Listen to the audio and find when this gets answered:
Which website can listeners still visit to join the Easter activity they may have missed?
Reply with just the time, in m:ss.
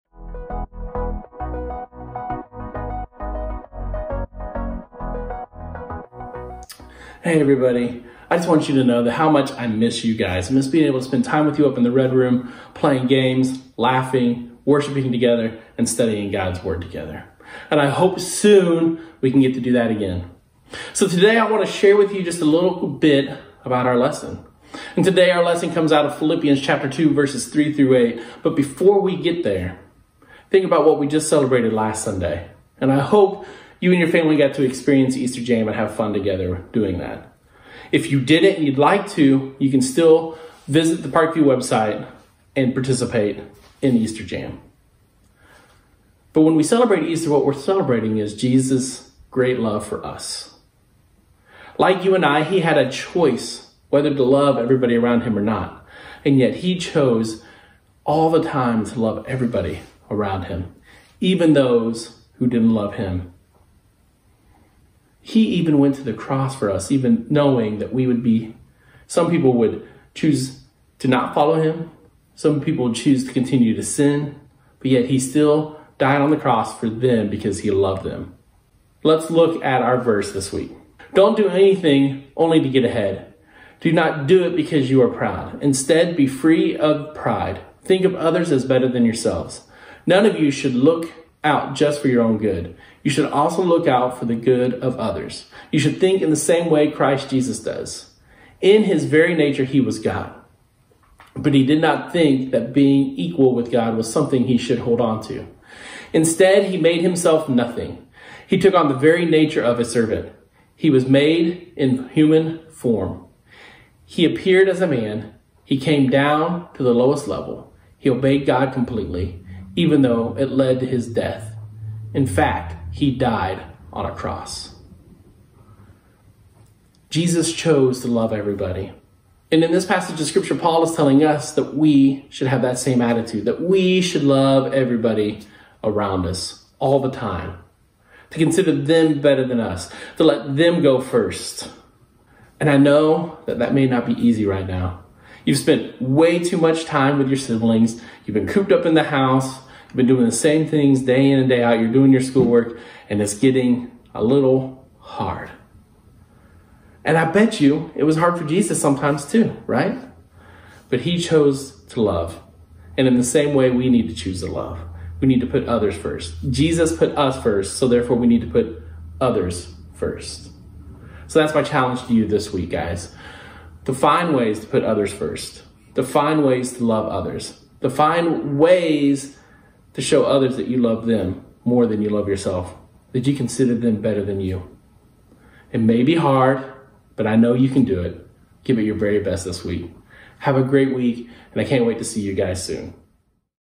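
0:41.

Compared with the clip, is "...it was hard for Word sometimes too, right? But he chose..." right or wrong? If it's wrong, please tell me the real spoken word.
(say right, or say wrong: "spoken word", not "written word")
wrong: "Jesus", not "Word".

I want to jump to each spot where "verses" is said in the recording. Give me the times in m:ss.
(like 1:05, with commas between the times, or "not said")
0:27, 1:19.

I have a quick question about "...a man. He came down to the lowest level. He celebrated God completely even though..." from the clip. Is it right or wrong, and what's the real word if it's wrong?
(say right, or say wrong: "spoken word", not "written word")
wrong: "obeyed", not "celebrated".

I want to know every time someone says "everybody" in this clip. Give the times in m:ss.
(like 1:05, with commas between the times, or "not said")
0:07, 0:54, 0:59, 2:08, 2:14.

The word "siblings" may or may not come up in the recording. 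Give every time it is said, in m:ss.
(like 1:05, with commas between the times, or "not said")
2:27.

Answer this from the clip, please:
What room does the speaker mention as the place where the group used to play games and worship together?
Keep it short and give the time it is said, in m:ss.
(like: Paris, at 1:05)
The Red Room, at 0:11.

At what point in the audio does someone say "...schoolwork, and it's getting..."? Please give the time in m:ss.
2:32.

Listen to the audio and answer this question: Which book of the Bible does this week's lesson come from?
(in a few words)
Philippians.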